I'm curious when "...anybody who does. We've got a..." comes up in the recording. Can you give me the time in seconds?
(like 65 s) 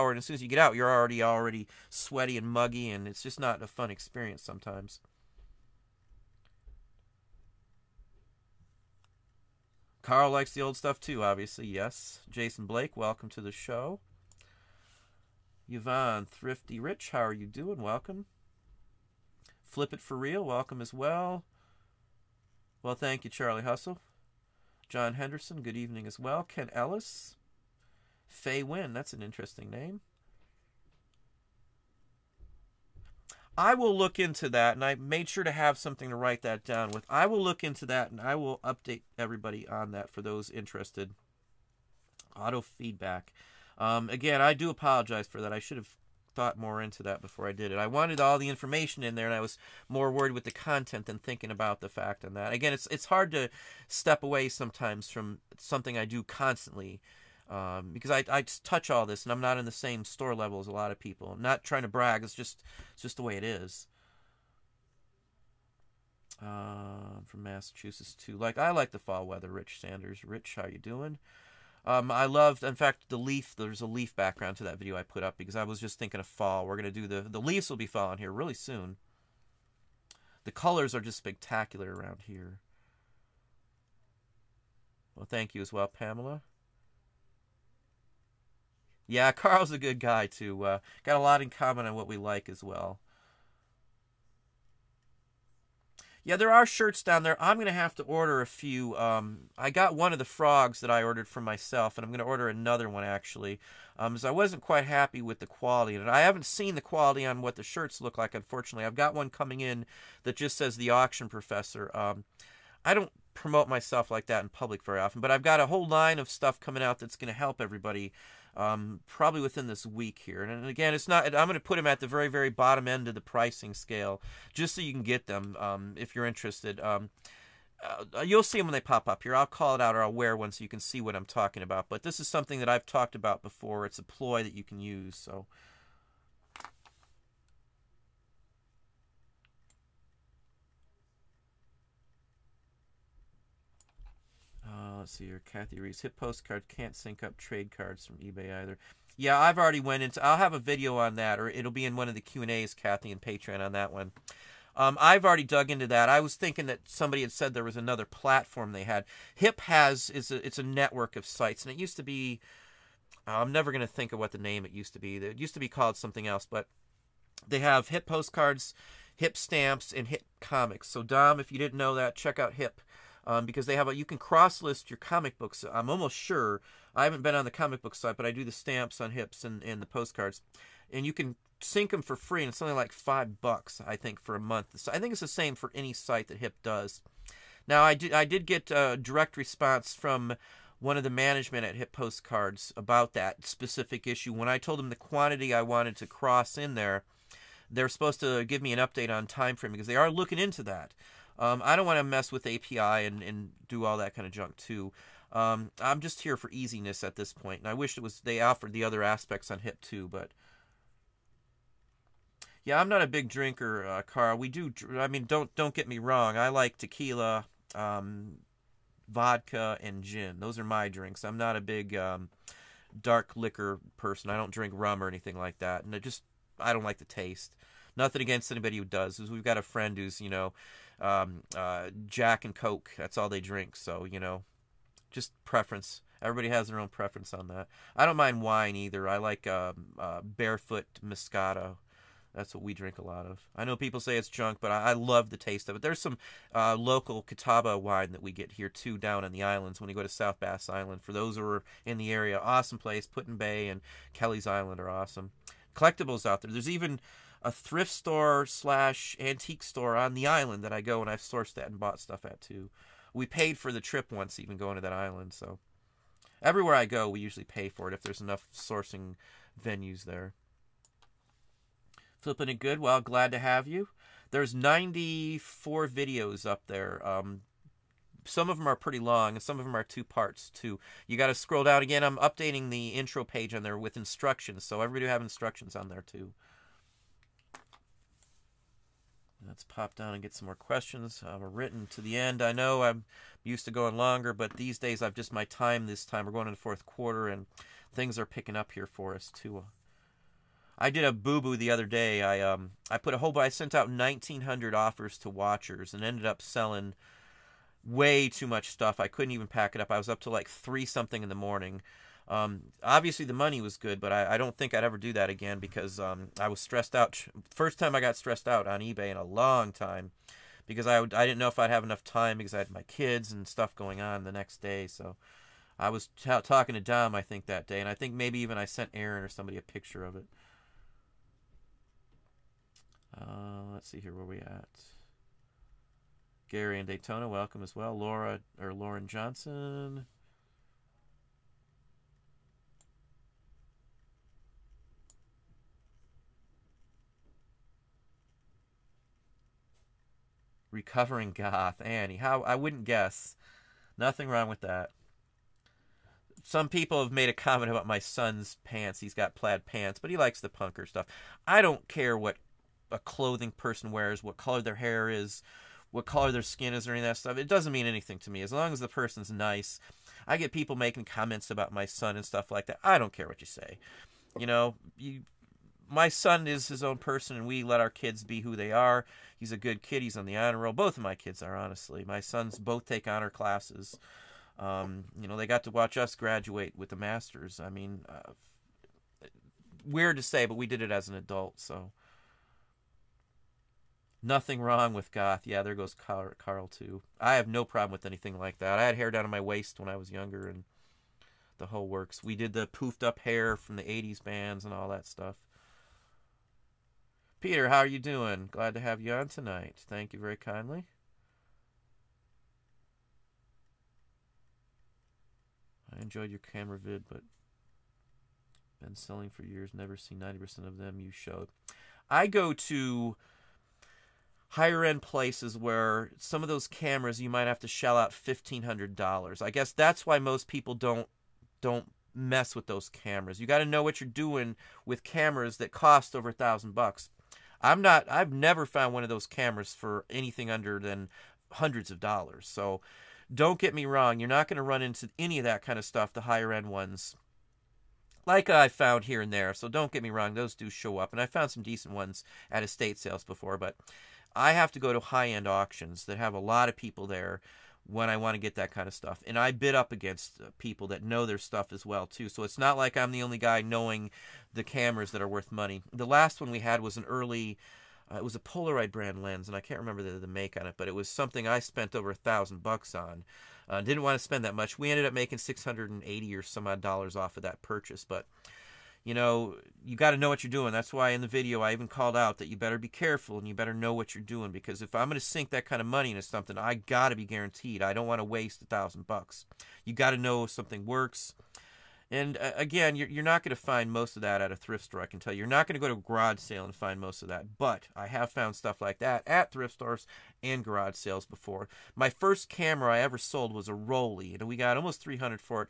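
228 s.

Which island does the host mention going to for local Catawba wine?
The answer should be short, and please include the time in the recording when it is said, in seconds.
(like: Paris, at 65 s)
South Bass Island, at 250 s.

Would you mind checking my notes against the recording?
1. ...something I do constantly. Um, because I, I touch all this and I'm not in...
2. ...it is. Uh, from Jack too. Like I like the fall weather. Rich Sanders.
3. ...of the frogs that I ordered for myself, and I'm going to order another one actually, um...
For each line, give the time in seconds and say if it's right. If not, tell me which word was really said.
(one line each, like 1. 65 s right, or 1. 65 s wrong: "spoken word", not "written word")
1. 55 s right
2. 63 s wrong: "Massachusetts", not "Jack"
3. 100 s right.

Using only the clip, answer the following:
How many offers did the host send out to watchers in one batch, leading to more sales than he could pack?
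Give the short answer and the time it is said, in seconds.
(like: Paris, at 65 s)
1,900, at 303 s.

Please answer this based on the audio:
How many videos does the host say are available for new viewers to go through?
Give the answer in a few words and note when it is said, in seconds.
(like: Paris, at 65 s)
94, at 274 s.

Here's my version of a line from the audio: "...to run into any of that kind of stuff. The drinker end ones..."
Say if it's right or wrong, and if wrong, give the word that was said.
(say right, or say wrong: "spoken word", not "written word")
wrong: "higher", not "drinker".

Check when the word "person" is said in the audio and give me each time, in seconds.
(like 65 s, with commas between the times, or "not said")
223 s, 363 s, 368 s, 376 s.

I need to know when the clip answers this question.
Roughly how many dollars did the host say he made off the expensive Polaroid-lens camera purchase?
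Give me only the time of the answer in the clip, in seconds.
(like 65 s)
475 s.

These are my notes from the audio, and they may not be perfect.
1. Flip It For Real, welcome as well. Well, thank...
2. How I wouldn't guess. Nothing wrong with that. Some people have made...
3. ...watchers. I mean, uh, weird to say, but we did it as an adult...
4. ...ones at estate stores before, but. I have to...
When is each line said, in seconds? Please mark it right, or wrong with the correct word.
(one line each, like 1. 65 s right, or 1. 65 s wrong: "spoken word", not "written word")
1. 19 s right
2. 352 s right
3. 386 s wrong: "masters", not "watchers"
4. 451 s wrong: "sales", not "stores".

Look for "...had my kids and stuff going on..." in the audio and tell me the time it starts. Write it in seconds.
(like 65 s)
322 s.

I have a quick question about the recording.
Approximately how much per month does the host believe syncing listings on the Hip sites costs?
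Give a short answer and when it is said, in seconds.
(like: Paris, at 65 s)
$5, at 182 s.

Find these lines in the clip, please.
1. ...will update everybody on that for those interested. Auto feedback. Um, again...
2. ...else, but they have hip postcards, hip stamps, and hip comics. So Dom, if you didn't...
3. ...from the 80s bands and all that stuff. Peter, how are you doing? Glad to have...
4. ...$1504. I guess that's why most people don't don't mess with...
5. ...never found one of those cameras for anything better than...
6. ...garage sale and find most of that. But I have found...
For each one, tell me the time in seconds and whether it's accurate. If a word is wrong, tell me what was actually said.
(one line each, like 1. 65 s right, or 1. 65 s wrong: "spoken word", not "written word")
1. 38 s right
2. 166 s right
3. 403 s right
4. 428 s wrong: "1500", not "1504"
5. 438 s wrong: "under", not "better"
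6. 495 s right.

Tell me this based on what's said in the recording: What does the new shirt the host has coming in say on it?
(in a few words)
the auction professor.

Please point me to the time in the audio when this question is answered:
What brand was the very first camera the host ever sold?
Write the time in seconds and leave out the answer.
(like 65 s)
503 s.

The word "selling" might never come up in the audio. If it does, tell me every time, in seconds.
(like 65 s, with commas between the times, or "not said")
306 s, 418 s.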